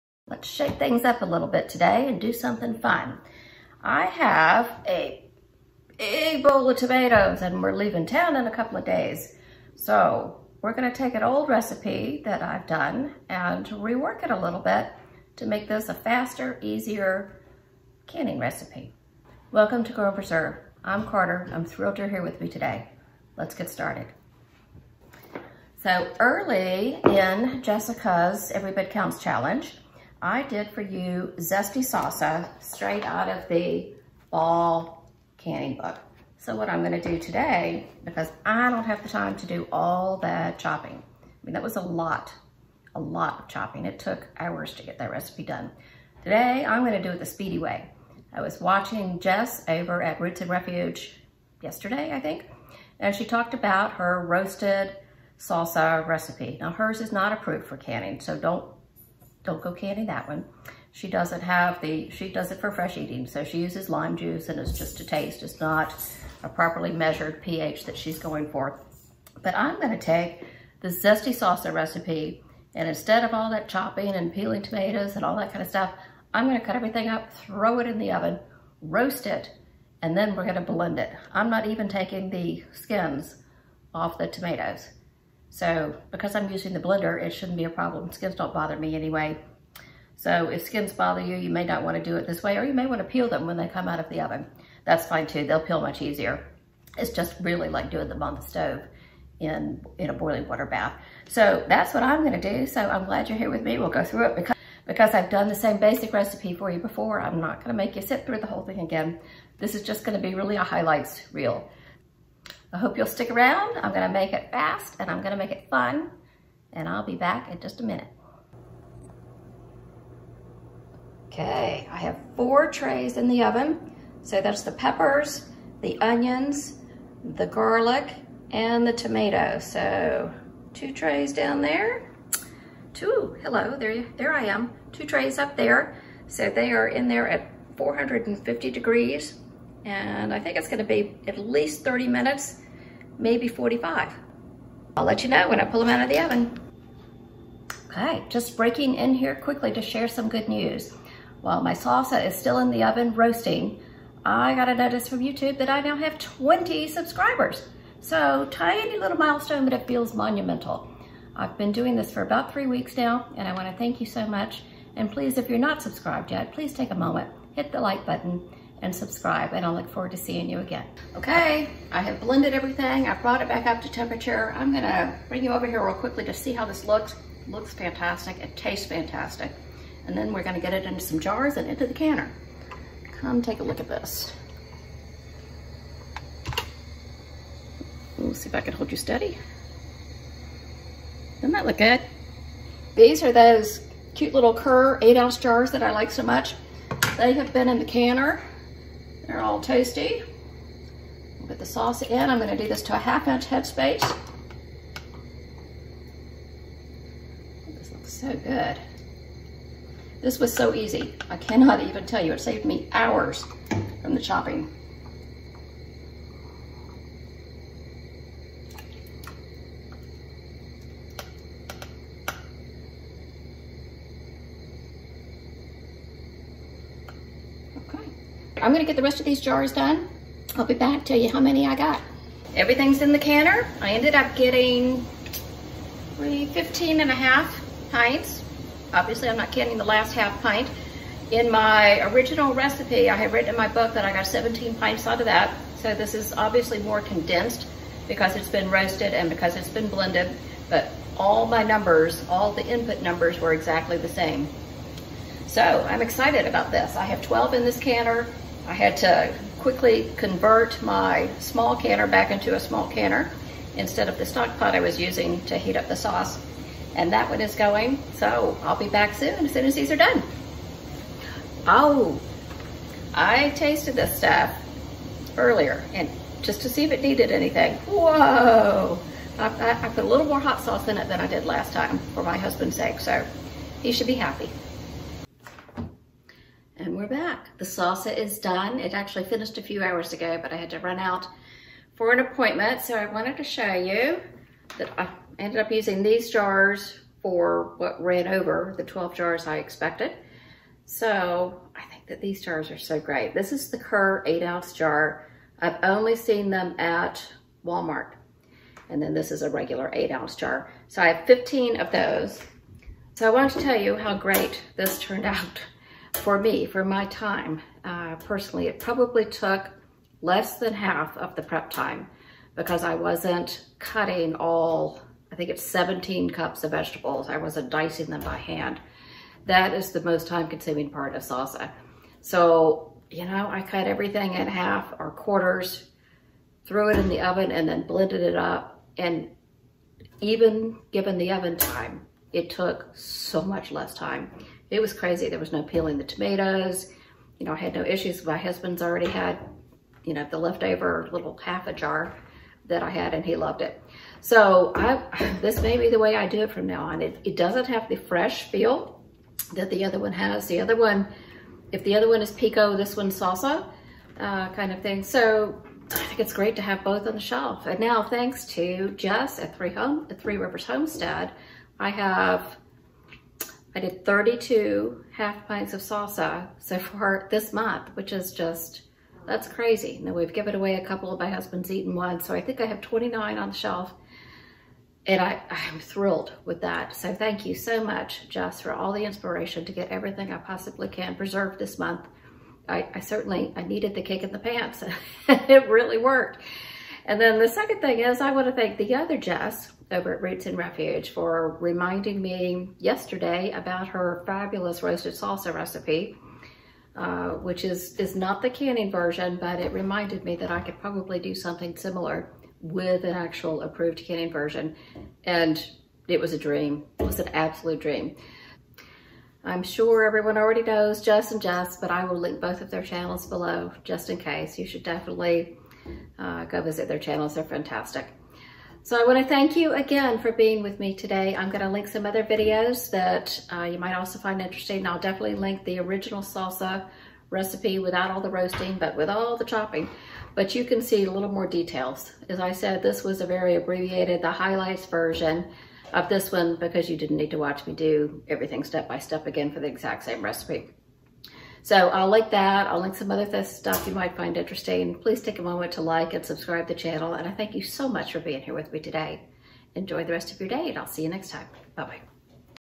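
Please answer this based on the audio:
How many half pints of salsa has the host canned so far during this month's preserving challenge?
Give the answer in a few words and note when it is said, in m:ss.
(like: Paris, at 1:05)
32, at 6:14.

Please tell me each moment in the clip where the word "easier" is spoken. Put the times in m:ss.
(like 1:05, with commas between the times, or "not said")
0:16, 1:36.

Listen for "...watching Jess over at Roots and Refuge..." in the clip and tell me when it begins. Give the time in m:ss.
0:48.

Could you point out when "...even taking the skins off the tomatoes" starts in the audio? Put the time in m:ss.
1:21.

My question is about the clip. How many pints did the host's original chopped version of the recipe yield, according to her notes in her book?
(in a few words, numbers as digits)
17.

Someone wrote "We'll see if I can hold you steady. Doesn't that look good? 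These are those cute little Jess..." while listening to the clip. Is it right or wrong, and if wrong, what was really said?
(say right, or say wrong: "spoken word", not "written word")
wrong: "Kerr", not "Jess".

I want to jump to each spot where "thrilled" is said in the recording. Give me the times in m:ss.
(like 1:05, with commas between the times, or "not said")
0:21, 6:25.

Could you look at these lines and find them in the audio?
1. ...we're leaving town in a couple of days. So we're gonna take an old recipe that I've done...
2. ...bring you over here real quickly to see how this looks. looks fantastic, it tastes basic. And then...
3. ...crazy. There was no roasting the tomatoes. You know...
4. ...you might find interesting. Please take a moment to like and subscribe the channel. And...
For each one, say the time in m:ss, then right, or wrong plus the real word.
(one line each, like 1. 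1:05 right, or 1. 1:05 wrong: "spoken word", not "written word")
1. 0:07 right
2. 2:55 wrong: "fantastic", not "basic"
3. 5:44 wrong: "peeling", not "roasting"
4. 7:33 right.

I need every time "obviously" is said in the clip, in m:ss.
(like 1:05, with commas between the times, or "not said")
3:58, 4:06.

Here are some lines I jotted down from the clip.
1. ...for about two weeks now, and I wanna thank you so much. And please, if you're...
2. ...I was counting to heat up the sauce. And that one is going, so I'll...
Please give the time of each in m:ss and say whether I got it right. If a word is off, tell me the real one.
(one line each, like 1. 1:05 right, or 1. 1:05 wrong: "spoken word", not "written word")
1. 2:42 wrong: "three", not "two"
2. 4:24 wrong: "using", not "counting".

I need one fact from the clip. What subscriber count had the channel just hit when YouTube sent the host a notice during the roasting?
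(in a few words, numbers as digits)
20.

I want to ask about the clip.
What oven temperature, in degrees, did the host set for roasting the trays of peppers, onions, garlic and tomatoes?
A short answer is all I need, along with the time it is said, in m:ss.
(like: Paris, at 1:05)
450, at 2:17.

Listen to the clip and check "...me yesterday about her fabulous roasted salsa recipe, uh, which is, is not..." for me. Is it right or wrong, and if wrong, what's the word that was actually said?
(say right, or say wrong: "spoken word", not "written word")
right.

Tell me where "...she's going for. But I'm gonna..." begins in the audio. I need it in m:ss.
1:07.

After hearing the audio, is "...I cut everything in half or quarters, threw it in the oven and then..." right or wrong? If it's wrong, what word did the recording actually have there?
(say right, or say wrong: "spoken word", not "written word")
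right.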